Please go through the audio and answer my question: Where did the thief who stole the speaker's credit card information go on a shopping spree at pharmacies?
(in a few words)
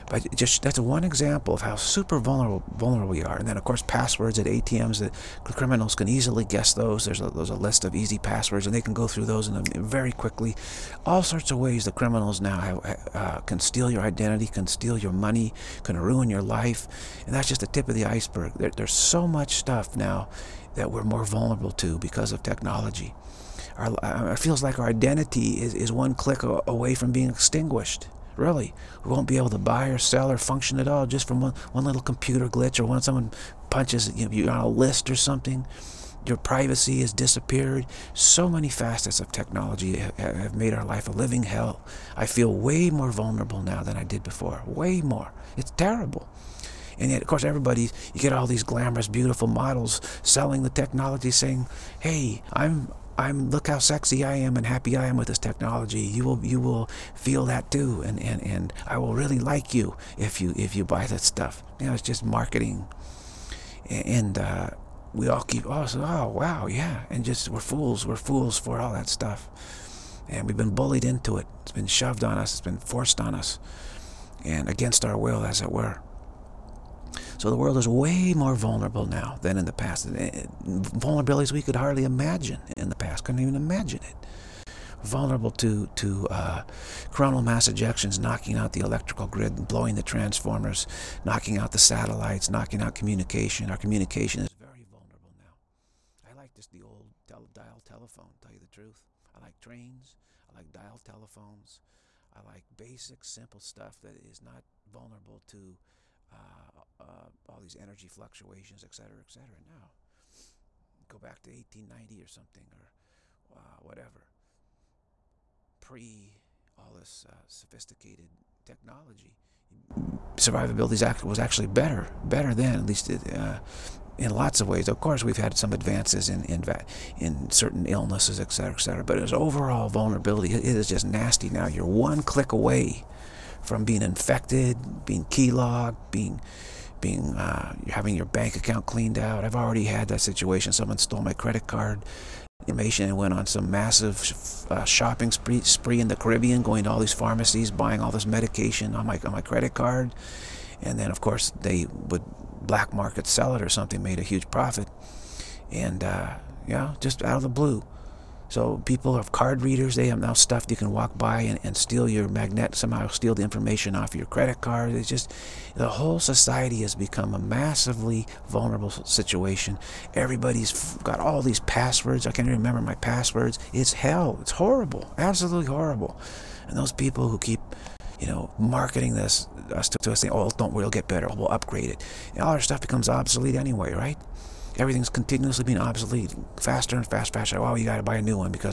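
the Caribbean.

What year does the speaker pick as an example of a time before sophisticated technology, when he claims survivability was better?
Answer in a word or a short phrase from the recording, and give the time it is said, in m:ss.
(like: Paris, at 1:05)
1890, at 1:51.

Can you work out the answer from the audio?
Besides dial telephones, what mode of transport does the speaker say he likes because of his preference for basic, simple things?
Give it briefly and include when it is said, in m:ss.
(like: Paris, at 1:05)
trains, at 1:39.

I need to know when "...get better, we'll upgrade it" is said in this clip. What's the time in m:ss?
3:00.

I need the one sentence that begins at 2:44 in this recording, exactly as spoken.
It's just the whole society has become a massively vulnerable situation.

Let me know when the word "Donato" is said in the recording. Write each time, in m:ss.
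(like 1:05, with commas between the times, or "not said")
not said.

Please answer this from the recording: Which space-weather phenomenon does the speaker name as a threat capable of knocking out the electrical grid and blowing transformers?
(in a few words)
coronal mass ejections.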